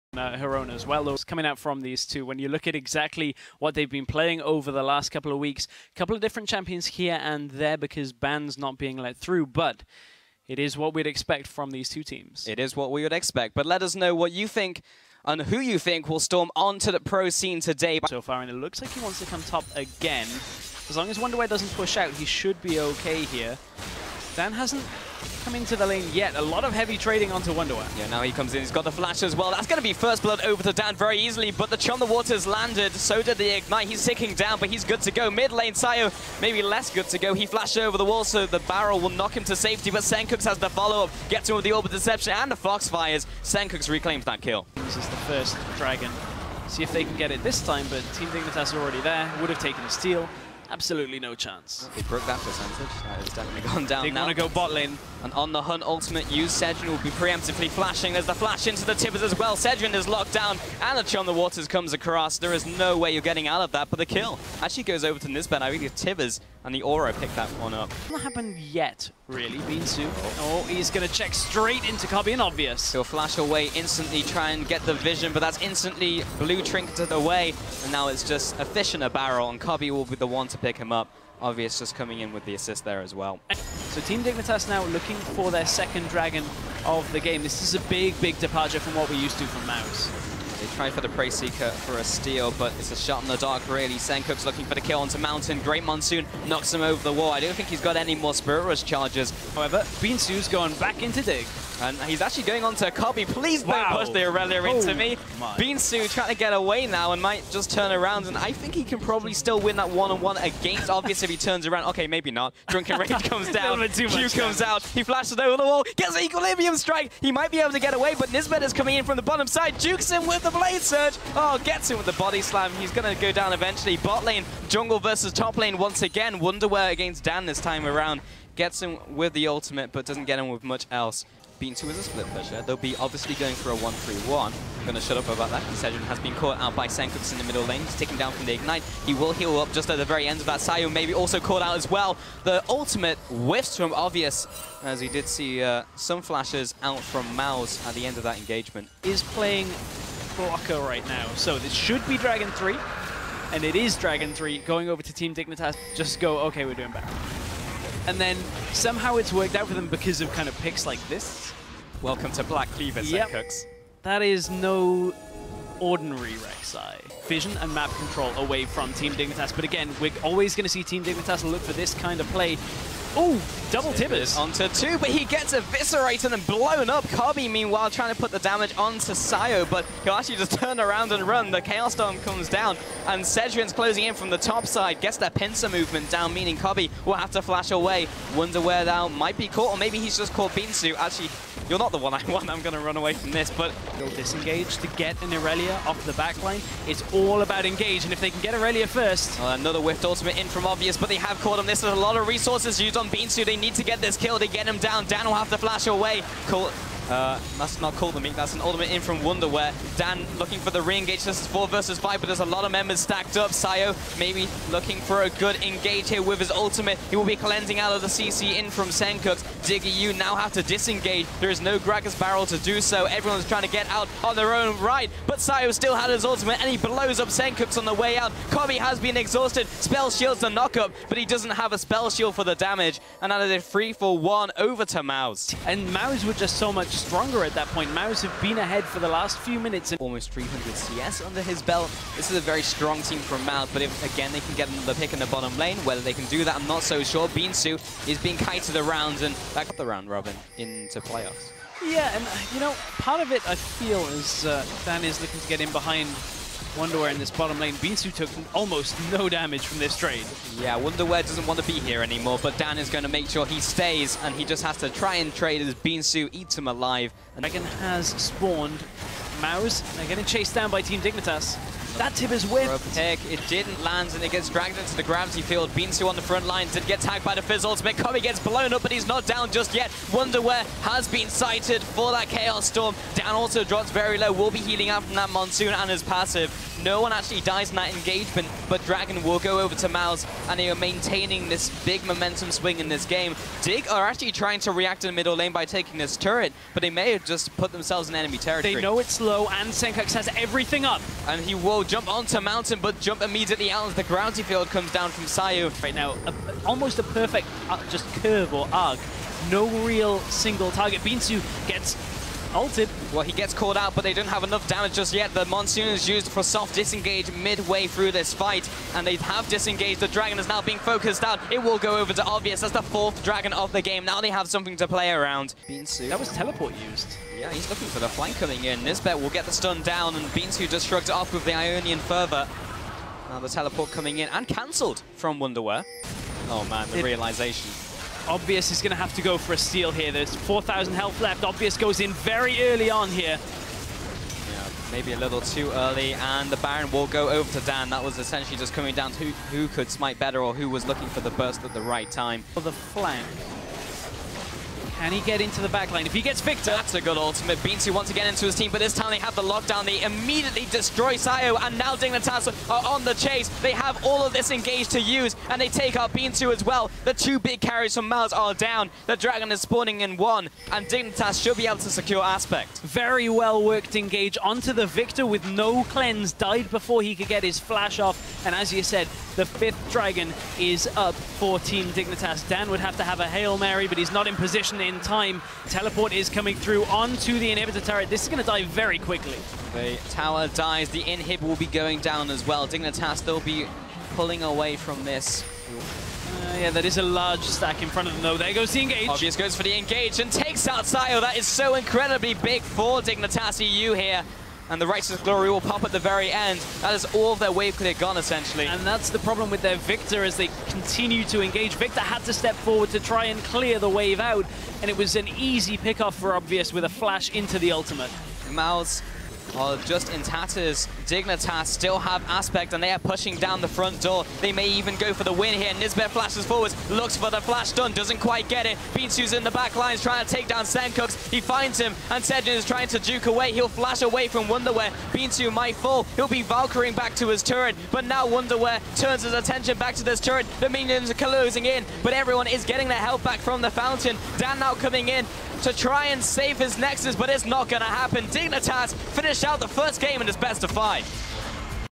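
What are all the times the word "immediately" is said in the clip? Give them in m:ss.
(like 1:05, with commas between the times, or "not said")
5:03, 6:00.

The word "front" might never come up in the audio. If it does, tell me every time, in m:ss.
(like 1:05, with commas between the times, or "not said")
4:36, 6:37, 7:03.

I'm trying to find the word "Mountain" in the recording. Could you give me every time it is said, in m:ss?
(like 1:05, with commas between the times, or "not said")
1:35, 5:02.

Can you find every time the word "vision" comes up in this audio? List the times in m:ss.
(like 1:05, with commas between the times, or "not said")
1:14, 2:47.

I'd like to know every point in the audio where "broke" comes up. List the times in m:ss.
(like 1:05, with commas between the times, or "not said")
0:52.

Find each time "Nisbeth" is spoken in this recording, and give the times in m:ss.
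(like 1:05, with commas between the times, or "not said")
1:05, 1:58, 5:28, 7:05.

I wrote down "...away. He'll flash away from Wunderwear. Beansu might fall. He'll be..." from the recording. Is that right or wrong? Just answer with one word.
right.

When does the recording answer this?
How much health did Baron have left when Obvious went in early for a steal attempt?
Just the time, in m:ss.
5:40.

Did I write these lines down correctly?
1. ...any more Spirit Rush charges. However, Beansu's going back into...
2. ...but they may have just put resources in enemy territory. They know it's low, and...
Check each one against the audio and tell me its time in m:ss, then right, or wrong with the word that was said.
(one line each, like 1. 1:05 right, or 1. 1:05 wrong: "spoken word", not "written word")
1. 1:37 right
2. 4:56 wrong: "themselves", not "resources".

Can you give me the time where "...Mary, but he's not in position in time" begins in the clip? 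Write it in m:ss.
6:23.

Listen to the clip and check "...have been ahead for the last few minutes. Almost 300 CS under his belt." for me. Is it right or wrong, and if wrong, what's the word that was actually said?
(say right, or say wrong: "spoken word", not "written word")
right.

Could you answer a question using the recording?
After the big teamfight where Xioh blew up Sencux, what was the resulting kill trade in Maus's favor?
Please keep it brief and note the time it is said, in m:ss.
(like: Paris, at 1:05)
3 for 1, at 3:53.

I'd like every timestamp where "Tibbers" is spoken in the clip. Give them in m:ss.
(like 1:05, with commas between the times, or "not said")
0:58, 1:06, 2:53.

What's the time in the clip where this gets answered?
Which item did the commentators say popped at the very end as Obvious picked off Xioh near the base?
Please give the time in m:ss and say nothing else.
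6:44.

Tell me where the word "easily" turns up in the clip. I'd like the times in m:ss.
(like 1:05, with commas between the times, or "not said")
0:31.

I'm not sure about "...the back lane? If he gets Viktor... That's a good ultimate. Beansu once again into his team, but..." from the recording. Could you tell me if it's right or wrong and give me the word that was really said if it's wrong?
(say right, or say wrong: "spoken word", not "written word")
right.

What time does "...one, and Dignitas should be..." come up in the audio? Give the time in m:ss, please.
6:10.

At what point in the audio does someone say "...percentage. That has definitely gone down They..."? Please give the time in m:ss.
0:52.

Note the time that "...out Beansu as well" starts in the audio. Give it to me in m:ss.
6:05.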